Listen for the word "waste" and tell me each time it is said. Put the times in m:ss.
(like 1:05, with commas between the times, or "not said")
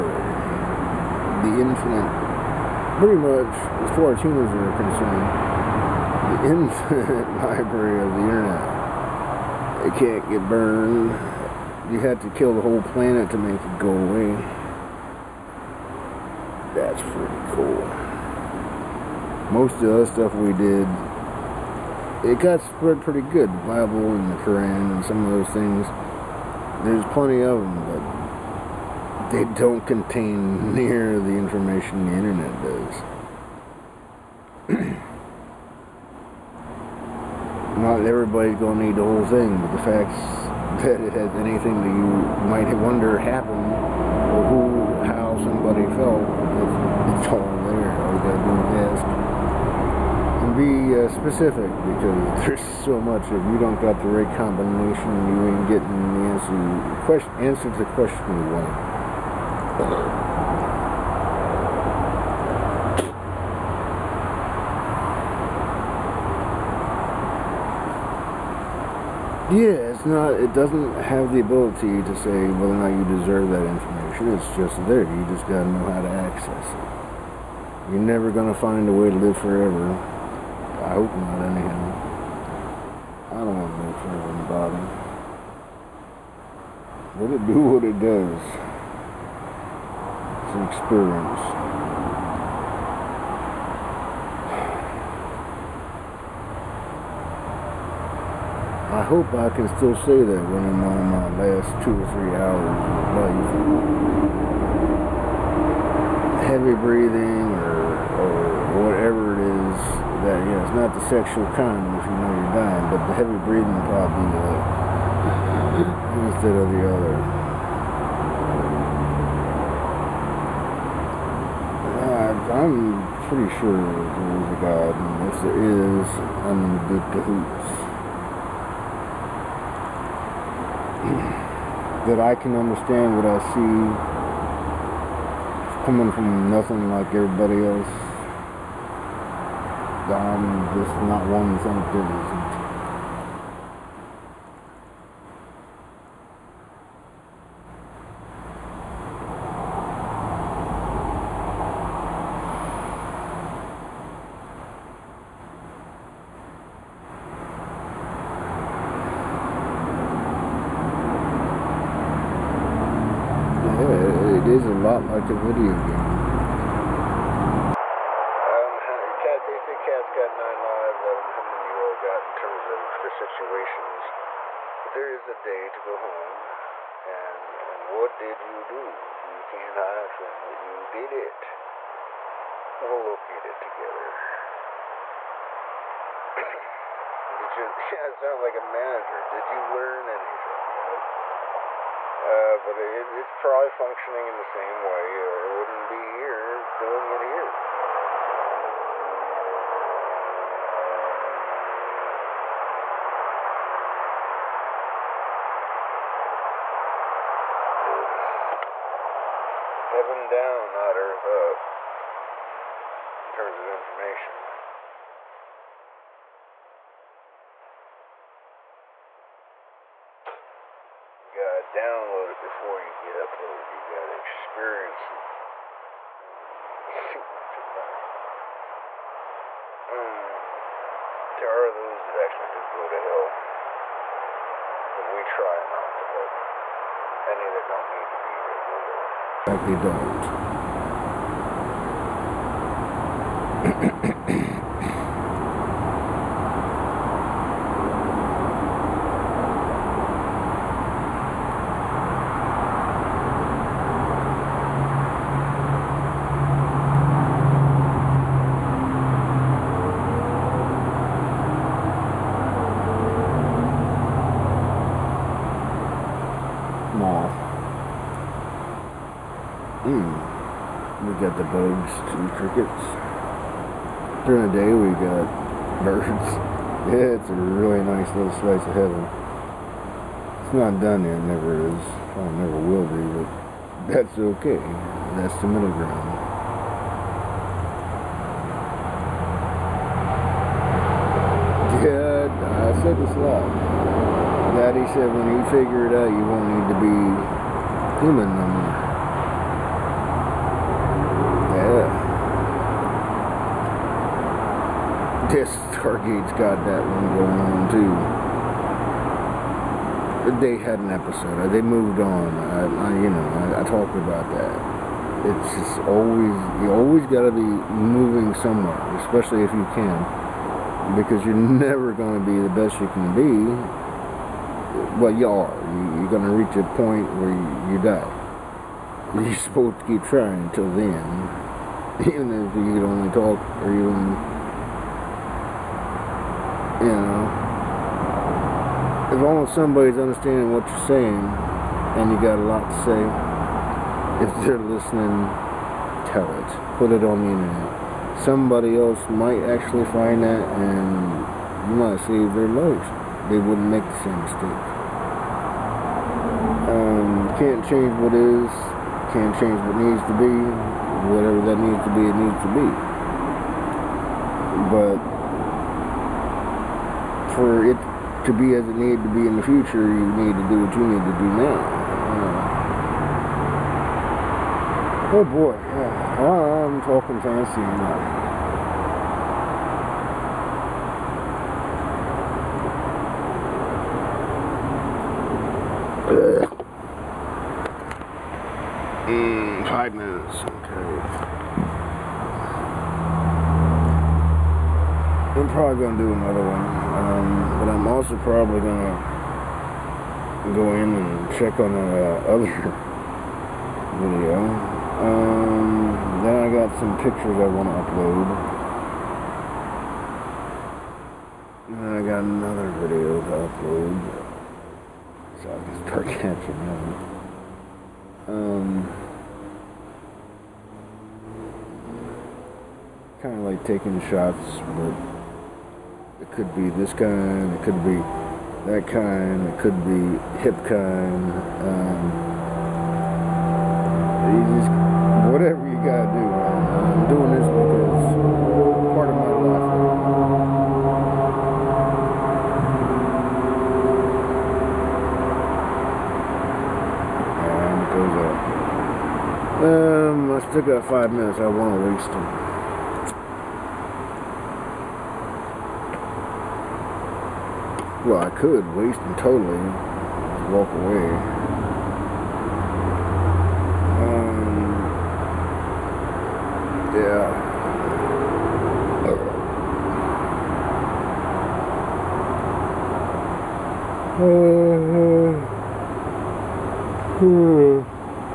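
7:31, 7:38.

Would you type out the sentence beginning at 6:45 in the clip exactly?
Um, then I got some pictures I want to upload.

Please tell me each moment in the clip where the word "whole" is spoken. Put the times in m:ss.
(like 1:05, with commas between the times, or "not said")
0:12, 0:39.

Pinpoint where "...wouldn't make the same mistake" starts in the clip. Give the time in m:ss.
5:53.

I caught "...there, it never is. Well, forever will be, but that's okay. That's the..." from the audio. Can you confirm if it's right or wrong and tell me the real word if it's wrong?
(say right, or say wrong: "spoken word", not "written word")
wrong: "never", not "forever".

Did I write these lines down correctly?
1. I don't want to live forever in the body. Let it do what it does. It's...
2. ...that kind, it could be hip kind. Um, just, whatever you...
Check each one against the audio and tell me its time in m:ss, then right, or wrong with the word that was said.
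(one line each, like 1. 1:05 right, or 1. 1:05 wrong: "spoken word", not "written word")
1. 1:23 right
2. 7:08 right.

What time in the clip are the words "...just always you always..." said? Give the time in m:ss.
5:15.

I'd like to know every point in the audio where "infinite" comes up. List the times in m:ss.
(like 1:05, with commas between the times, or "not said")
0:01, 0:06.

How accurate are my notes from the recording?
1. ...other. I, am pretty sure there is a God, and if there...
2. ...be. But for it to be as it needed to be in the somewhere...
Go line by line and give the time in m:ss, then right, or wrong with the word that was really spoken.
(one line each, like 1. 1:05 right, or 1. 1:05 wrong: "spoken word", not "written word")
1. 1:56 right
2. 6:02 wrong: "future", not "somewhere".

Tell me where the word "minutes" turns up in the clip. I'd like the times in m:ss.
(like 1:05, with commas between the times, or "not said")
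6:29, 7:31.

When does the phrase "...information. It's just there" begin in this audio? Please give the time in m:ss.
1:13.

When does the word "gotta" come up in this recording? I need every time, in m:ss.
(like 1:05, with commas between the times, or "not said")
1:15, 3:43, 7:15.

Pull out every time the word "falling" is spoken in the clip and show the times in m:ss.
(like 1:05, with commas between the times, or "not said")
not said.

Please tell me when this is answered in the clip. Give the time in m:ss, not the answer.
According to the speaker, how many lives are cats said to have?
2:50.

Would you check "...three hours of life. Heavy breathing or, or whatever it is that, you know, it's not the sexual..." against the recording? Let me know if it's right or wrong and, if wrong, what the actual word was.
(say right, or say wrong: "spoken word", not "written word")
right.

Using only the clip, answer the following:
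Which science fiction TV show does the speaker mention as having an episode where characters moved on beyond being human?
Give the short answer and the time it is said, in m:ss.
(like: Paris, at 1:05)
Stargate, at 5:05.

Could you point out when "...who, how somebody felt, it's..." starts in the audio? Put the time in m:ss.
0:44.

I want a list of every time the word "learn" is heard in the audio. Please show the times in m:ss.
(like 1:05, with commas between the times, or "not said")
3:09.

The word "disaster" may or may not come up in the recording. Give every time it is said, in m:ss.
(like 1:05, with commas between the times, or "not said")
not said.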